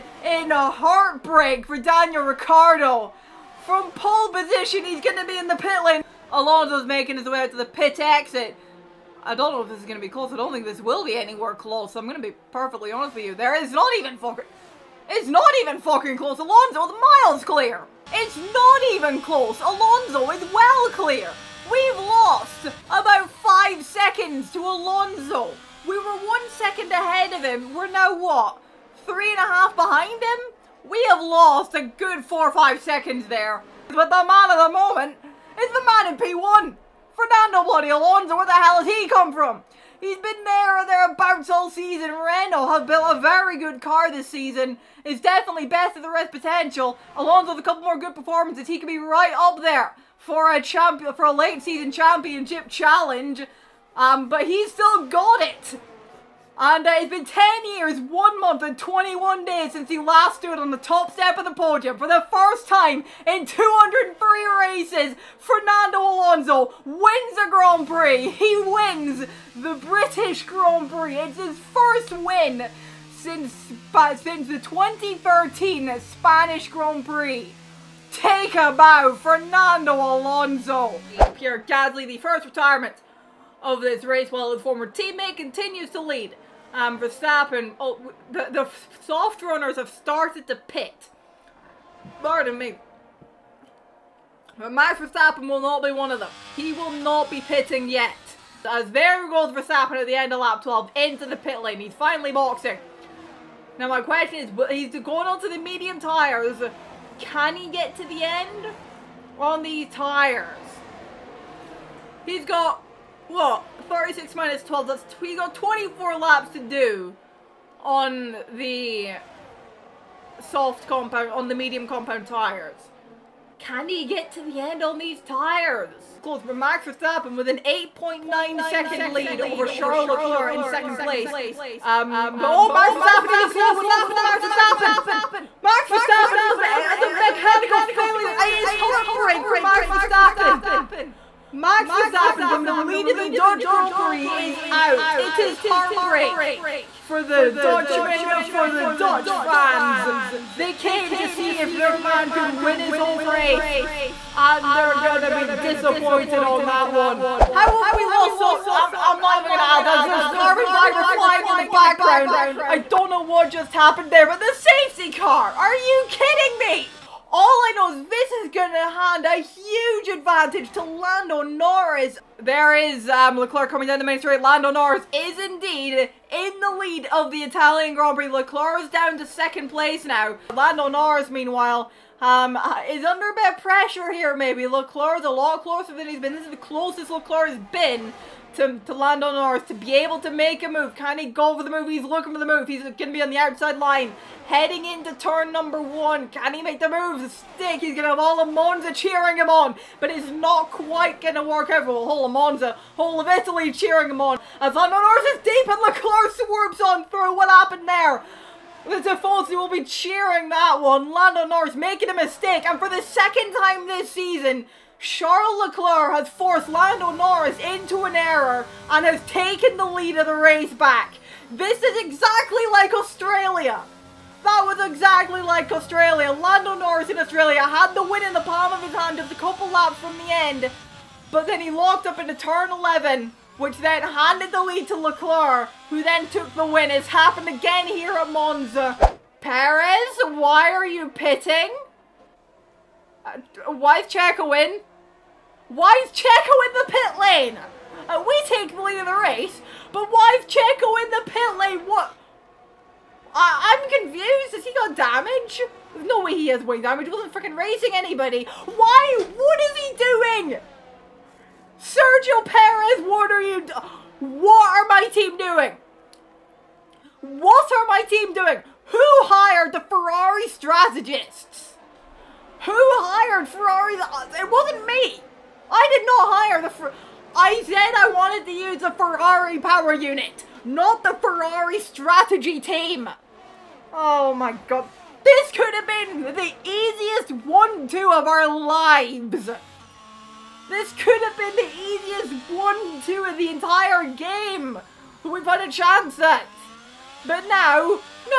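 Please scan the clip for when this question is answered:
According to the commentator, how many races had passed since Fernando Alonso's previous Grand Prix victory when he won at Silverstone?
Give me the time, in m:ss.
1:03.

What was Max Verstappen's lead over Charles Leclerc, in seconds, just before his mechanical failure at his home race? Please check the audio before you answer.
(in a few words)
8.9.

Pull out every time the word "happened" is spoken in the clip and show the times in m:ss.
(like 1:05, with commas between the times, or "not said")
2:13, 2:43, 3:27, 3:57.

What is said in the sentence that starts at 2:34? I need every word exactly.
And they're gonna be disappointed on that one.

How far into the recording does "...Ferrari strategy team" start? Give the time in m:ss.
4:41.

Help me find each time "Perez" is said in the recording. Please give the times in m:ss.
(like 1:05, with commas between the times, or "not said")
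3:59, 4:22.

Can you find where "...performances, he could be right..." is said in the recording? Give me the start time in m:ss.
0:48.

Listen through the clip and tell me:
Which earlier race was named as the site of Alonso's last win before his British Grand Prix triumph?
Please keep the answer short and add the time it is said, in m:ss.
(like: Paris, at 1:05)
2013 Spanish Grand Prix, at 1:14.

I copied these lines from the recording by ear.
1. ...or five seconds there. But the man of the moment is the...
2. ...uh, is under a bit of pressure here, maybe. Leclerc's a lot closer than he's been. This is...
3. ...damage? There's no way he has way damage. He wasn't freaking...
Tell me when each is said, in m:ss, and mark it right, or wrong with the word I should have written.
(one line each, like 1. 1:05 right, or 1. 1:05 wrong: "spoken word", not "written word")
1. 0:32 right
2. 3:02 right
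3. 4:14 right.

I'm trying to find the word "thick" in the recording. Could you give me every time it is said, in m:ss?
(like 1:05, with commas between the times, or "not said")
not said.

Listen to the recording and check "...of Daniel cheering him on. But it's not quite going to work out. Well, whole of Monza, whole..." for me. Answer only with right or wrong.
wrong.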